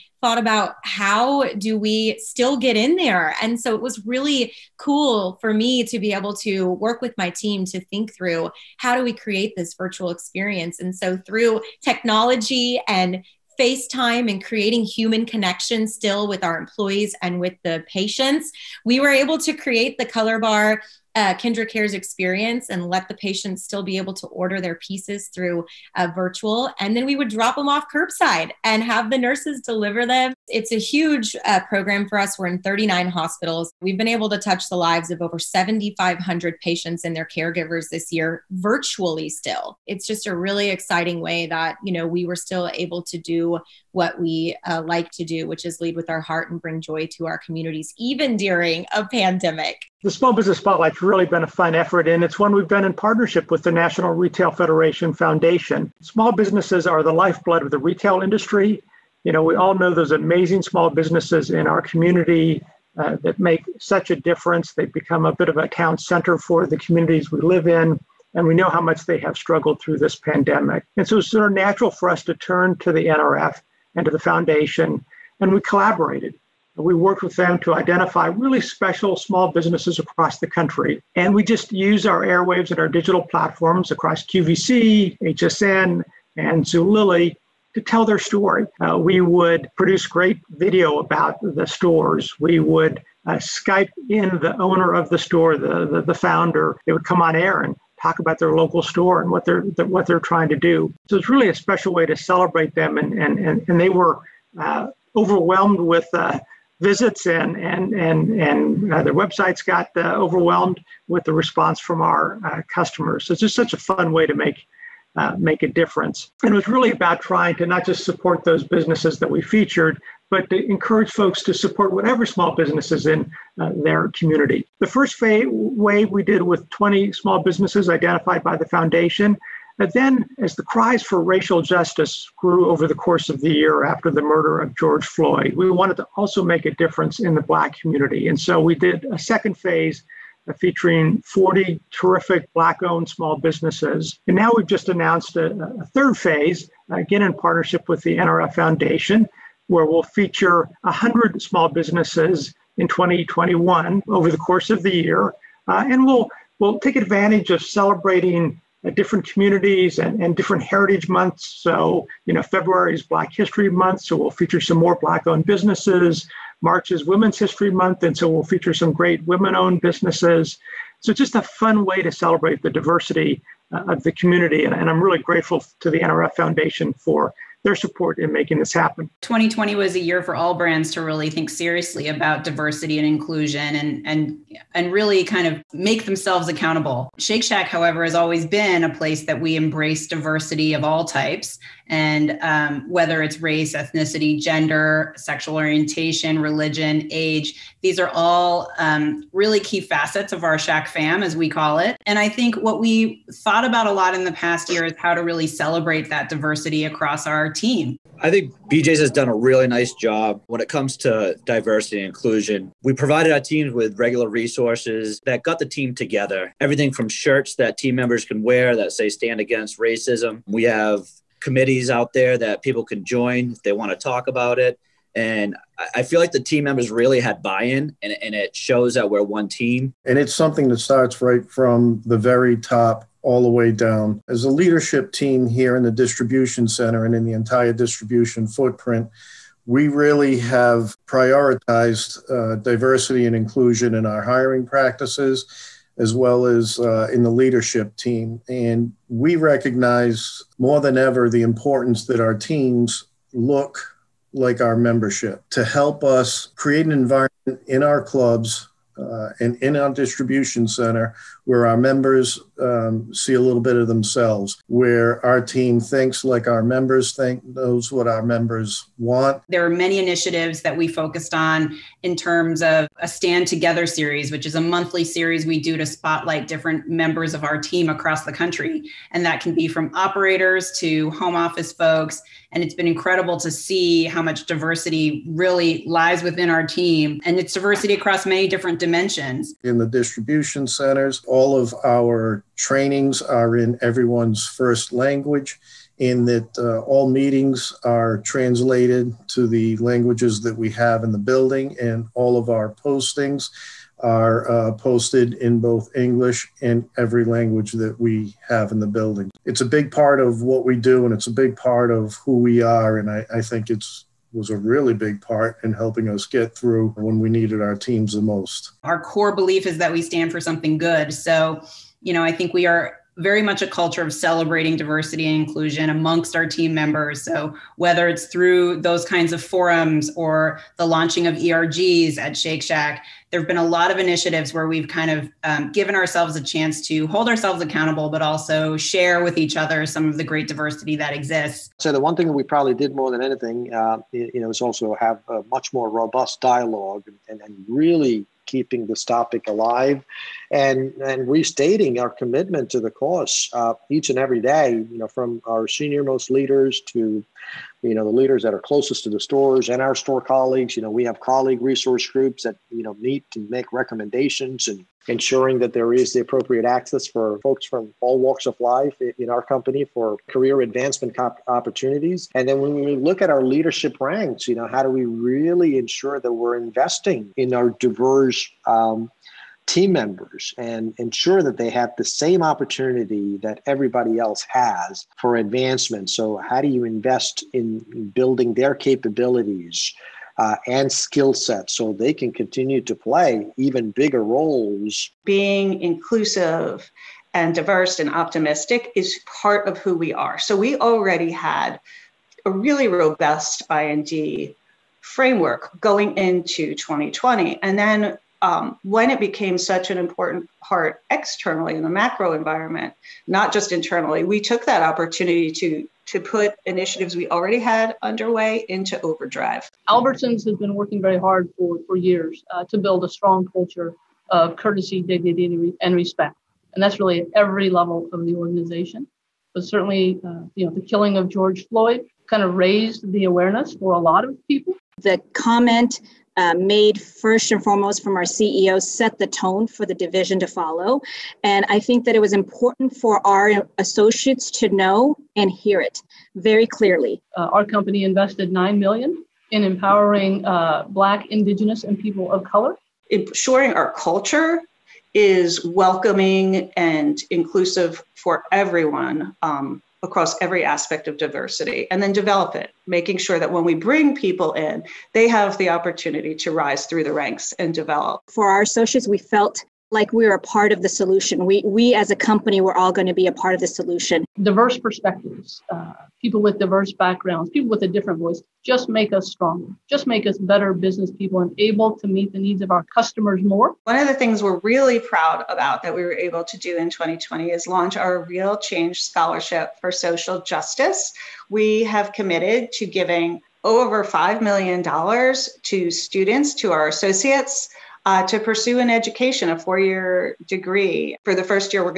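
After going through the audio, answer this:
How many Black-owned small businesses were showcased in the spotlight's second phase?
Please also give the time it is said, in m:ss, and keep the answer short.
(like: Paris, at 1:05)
40, at 2:21.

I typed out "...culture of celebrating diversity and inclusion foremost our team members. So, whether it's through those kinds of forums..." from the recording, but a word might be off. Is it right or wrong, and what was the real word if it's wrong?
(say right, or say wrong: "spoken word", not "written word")
wrong: "amongst", not "foremost".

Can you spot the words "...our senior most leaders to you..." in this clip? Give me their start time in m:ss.
5:55.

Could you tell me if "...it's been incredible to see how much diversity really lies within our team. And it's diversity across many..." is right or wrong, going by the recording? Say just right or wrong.
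right.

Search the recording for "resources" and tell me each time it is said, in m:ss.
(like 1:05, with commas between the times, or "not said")
3:34, 6:01.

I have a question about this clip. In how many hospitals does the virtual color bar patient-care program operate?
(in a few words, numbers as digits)
39.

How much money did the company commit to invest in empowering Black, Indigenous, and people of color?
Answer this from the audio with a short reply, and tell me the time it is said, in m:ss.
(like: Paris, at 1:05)
9 million, at 7:28.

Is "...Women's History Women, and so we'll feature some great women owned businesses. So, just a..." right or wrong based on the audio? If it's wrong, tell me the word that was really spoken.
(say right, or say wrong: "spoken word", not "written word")
wrong: "Month", not "Women".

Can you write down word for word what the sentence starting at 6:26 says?
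So, how do you invest in building their capabilities uh, and skill sets so they can continue to play even bigger roles?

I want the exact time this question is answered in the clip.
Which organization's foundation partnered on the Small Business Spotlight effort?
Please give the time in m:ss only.
0:53.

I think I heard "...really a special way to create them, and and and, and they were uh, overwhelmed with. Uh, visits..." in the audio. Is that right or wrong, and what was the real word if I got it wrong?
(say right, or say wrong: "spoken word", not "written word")
wrong: "celebrate", not "create".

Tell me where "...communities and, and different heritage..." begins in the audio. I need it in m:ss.
2:39.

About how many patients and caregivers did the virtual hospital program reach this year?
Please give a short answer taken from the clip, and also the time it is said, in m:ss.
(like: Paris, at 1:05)
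7,500, at 0:35.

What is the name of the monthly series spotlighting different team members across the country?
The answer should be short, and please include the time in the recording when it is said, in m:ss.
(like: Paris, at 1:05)
Stand Together, at 4:33.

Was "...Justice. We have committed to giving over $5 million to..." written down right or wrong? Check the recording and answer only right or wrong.
right.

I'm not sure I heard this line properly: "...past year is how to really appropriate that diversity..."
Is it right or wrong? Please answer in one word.
wrong.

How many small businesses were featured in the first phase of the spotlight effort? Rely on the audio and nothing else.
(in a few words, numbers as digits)
20.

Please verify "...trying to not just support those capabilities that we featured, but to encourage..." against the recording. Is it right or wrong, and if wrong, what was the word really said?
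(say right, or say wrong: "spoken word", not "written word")
wrong: "businesses", not "capabilities".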